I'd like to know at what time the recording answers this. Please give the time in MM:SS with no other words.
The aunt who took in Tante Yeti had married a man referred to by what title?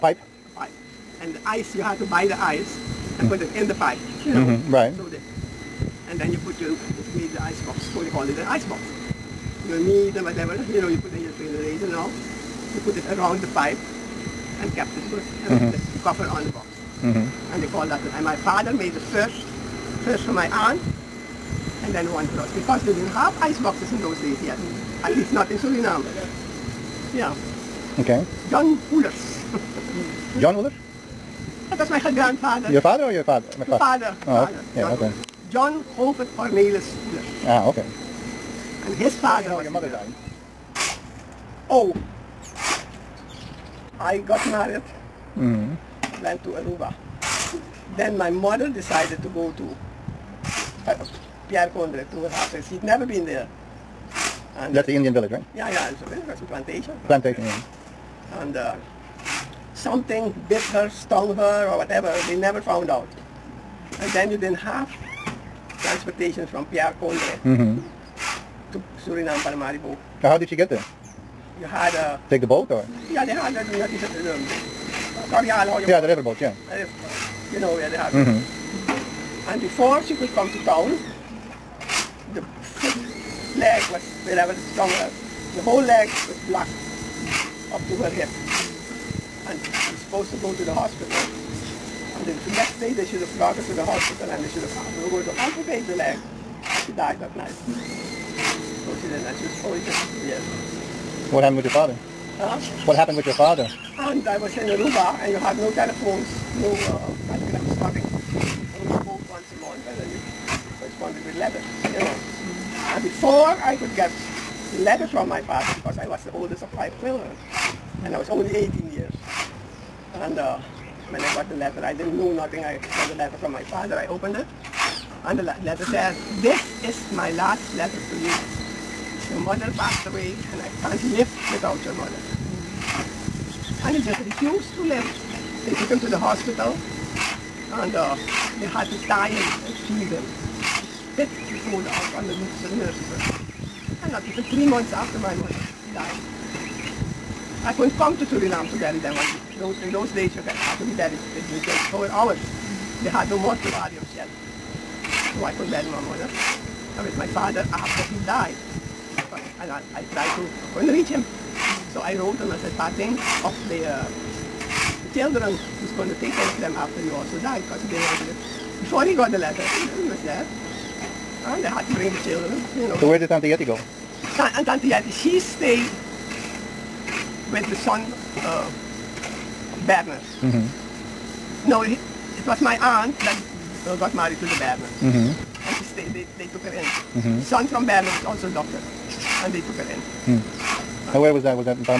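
03:04.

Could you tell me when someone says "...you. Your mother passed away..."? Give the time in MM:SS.
02:08.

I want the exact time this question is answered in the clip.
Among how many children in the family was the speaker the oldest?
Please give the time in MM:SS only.
01:56.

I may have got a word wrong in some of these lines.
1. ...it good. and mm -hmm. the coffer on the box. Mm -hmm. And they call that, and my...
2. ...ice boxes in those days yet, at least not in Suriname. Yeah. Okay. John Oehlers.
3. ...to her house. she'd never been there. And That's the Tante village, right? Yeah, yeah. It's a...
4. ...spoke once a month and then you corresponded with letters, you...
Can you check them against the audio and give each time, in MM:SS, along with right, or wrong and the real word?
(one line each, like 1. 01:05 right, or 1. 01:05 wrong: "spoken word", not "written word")
1. 00:14 right
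2. 00:23 right
3. 00:52 wrong: "Indian", not "Tante"
4. 01:48 right.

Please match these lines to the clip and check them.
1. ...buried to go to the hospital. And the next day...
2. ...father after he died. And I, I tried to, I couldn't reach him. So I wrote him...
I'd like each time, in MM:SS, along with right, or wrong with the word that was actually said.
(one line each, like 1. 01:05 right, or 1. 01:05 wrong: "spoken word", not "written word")
1. 01:30 wrong: "supposed", not "buried"
2. 02:37 right.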